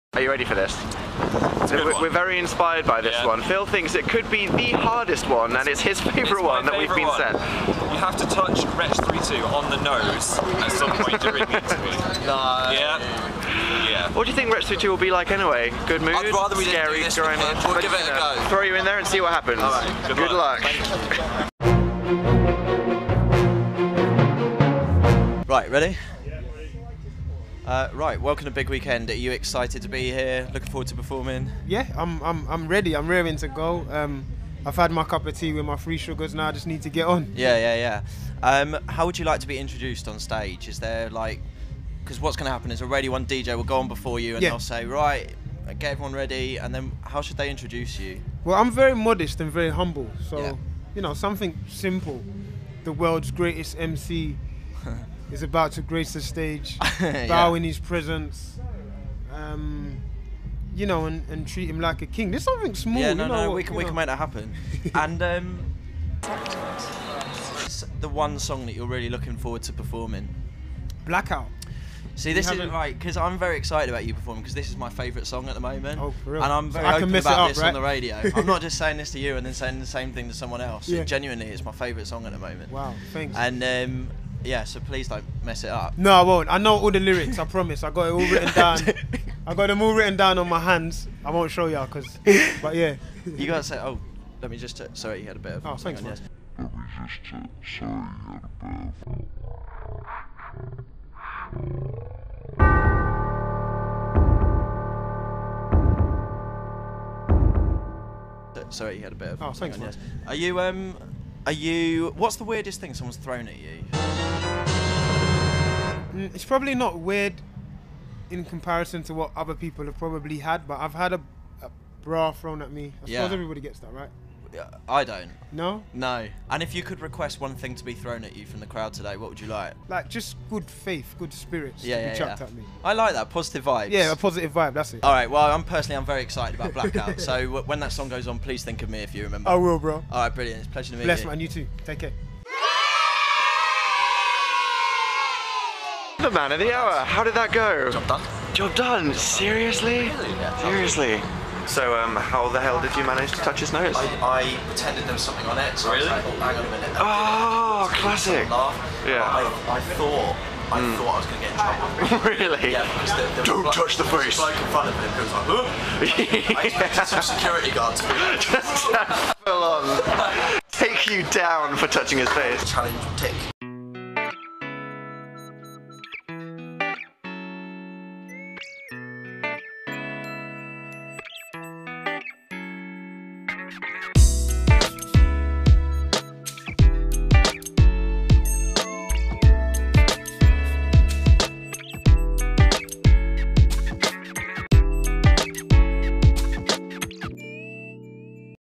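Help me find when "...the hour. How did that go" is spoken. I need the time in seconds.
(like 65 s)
146 s.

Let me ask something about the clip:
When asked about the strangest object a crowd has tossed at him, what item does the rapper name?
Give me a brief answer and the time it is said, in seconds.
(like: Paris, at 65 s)
A bra, at 121 s.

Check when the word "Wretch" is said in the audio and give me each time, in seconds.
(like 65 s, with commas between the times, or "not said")
8 s, 14 s.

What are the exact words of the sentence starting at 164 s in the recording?
The bloke in front of him goes like, huh?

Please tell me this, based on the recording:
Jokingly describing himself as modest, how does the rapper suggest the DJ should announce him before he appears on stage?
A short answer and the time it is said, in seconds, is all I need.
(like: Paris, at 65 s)
The world's greatest MC, at 52 s.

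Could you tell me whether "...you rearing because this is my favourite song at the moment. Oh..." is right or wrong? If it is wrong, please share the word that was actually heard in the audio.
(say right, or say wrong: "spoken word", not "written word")
wrong: "performing", not "rearing".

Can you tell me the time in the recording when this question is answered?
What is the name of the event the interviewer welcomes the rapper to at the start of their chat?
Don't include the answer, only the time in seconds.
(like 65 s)
28 s.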